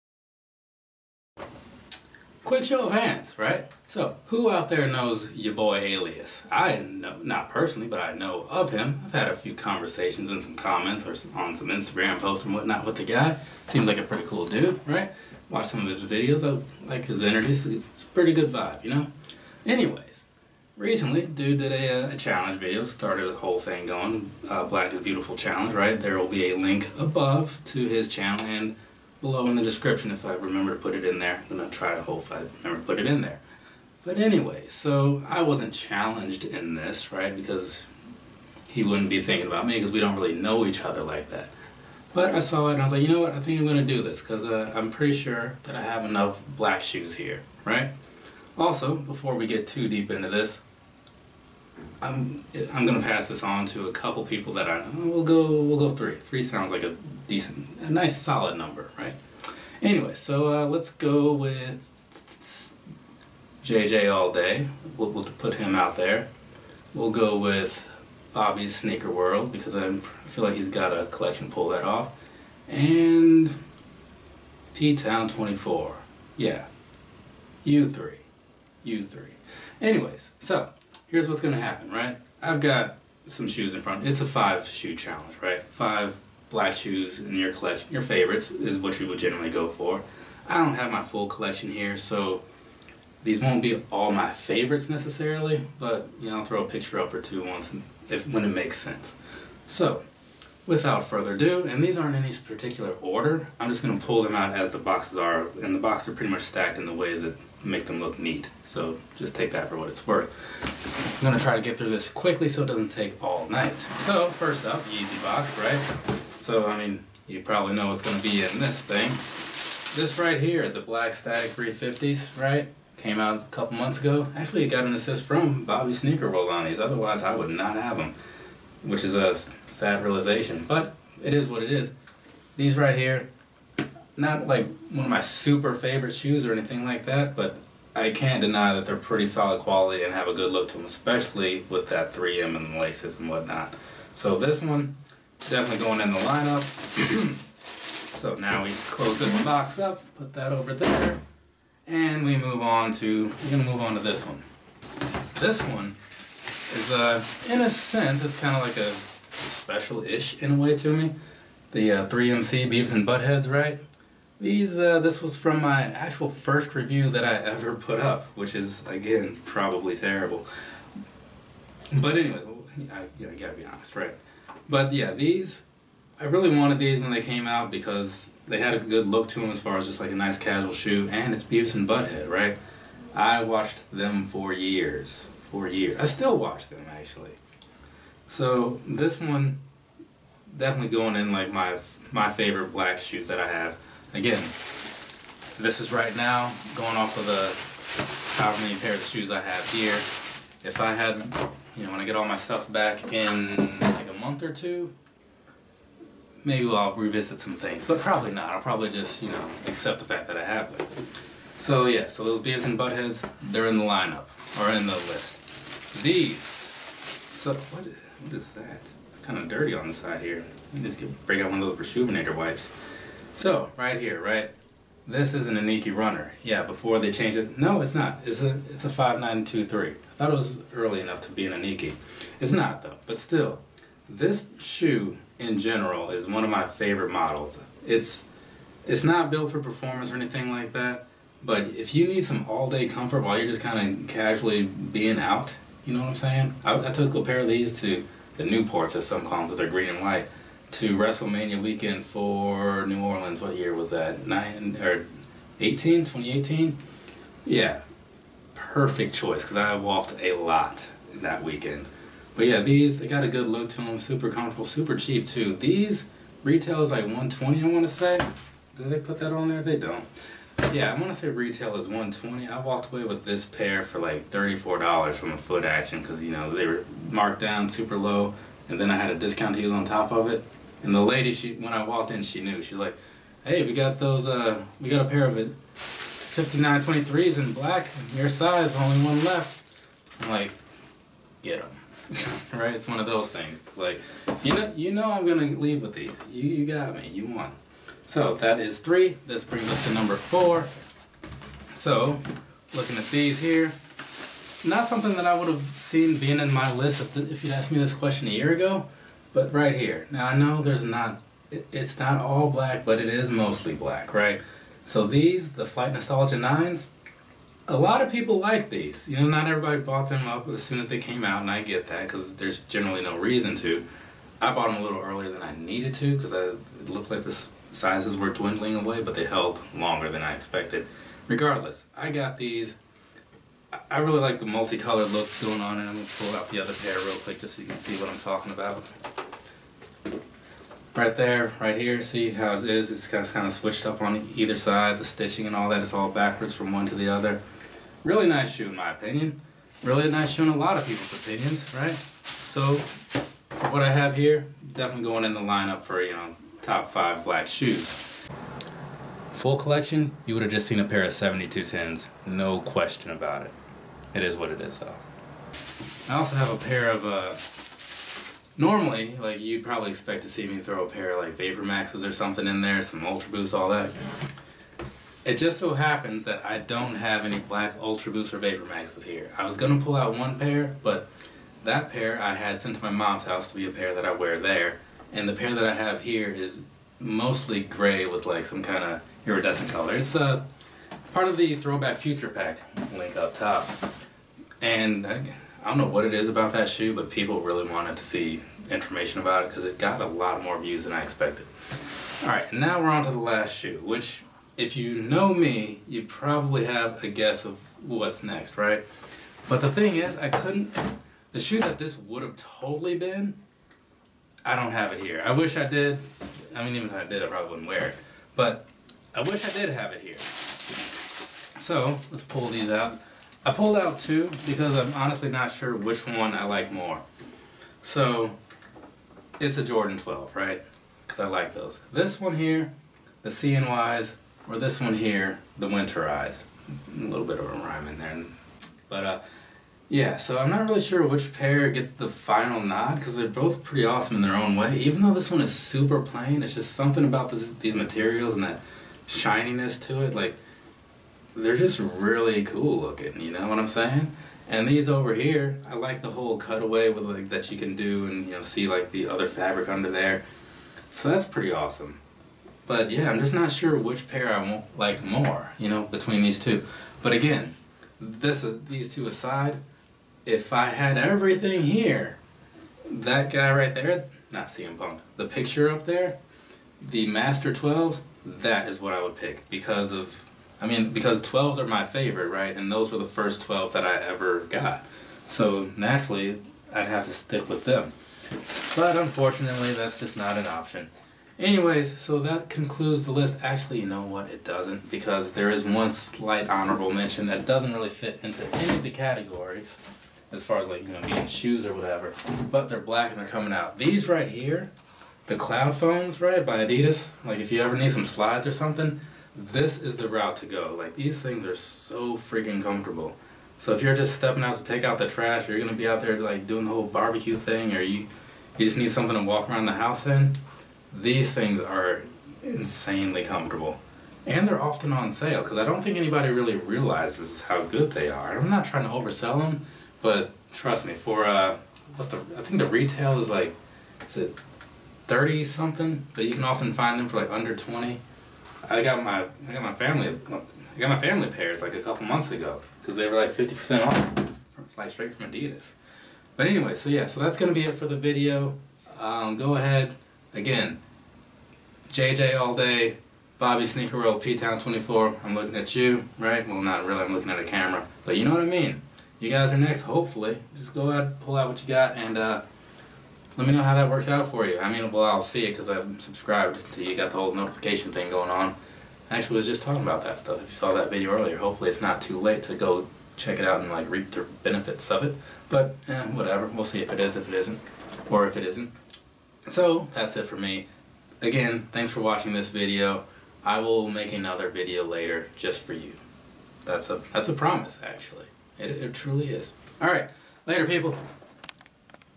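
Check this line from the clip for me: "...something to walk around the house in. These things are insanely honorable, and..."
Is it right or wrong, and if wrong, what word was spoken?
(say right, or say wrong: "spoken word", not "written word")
wrong: "comfortable", not "honorable".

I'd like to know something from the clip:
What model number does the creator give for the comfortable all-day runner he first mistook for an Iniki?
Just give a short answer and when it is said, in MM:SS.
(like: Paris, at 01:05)
5923, at 03:48.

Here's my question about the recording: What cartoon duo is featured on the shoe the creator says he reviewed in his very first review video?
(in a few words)
Beavis and Butthead.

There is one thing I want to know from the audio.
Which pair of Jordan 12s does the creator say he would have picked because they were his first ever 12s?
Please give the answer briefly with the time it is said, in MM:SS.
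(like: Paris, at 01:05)
Master 12s, at 07:57.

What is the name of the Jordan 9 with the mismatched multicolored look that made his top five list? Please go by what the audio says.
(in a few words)
Flight Nostalgia 9s.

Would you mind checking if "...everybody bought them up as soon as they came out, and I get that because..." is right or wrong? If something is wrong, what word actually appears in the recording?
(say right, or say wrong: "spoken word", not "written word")
right.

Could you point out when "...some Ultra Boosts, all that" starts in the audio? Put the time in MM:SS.
06:12.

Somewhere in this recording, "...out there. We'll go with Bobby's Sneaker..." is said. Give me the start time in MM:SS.
01:05.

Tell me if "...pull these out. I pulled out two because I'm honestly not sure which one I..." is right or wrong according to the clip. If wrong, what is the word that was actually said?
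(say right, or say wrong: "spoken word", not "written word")
right.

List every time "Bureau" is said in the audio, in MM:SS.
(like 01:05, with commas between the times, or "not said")
not said.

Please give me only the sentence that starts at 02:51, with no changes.
But anyways, I, you know, gotta be honest, right?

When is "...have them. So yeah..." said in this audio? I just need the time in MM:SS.
03:30.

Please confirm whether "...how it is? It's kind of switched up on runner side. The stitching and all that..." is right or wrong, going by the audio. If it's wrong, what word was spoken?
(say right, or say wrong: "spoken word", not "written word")
wrong: "either", not "runner".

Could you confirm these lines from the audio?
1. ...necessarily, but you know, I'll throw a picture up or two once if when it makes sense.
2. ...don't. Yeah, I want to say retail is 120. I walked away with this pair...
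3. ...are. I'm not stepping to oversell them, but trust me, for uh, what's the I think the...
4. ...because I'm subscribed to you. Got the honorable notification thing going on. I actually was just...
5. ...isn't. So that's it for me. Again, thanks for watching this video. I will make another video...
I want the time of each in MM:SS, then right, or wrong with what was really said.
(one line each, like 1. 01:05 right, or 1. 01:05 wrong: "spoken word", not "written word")
1. 01:34 right
2. 04:29 right
3. 08:48 wrong: "trying", not "stepping"
4. 09:25 wrong: "whole", not "honorable"
5. 09:38 right.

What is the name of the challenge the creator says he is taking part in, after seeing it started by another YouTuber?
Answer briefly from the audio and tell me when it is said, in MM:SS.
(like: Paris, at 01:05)
Black is Beautiful Challenge, at 00:24.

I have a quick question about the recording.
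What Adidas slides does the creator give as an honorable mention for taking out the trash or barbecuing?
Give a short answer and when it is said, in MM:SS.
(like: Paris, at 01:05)
Cloudfoams, at 08:25.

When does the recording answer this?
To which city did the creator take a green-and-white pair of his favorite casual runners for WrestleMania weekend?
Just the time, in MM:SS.
04:12.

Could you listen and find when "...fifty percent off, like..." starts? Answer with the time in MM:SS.
09:03.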